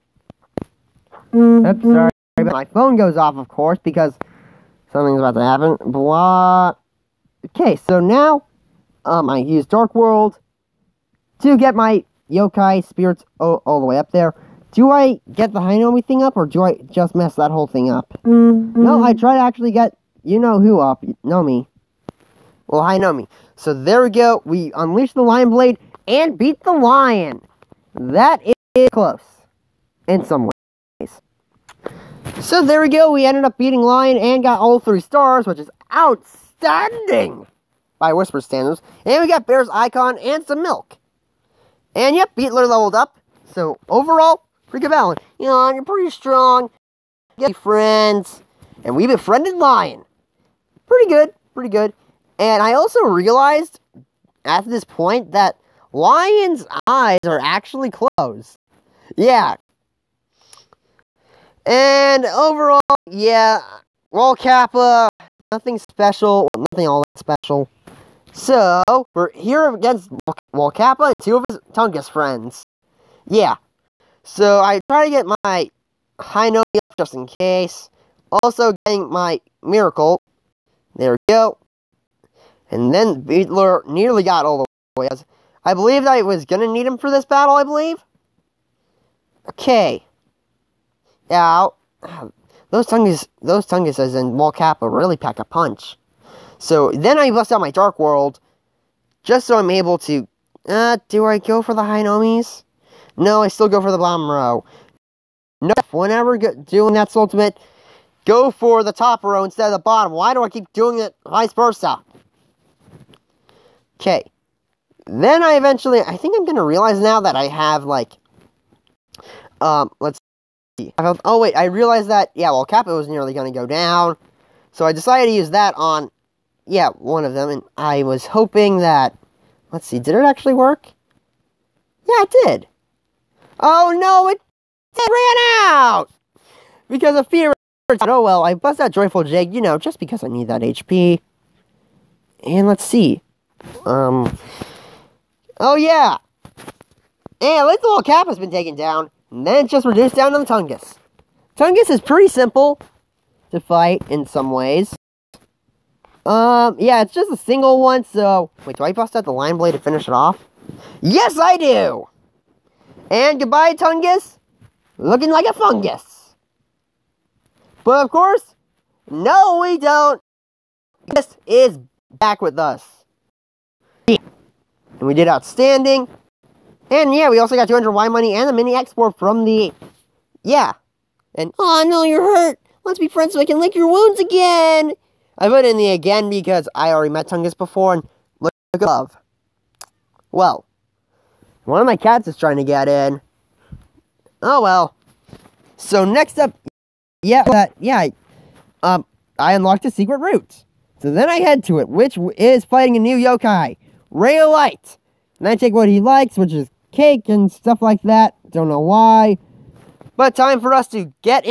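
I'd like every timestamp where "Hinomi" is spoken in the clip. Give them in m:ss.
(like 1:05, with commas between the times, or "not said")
1:16, 1:41.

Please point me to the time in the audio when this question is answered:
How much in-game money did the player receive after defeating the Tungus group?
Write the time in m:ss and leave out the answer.
2:57.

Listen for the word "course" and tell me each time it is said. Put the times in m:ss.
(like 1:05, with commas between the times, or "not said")
0:03, 2:48.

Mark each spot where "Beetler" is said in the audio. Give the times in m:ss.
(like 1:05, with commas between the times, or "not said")
0:42, 1:23.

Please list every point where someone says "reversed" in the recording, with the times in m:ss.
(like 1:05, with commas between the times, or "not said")
not said.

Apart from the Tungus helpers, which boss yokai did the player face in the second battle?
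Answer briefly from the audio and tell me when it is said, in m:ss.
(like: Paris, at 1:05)
Wall Kappa, at 1:10.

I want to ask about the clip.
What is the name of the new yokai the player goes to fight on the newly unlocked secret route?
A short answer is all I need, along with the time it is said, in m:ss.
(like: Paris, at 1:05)
Ray of Light, at 3:24.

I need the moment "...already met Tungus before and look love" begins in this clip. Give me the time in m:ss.
3:06.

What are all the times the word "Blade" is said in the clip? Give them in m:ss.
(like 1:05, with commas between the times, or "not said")
0:25, 2:39.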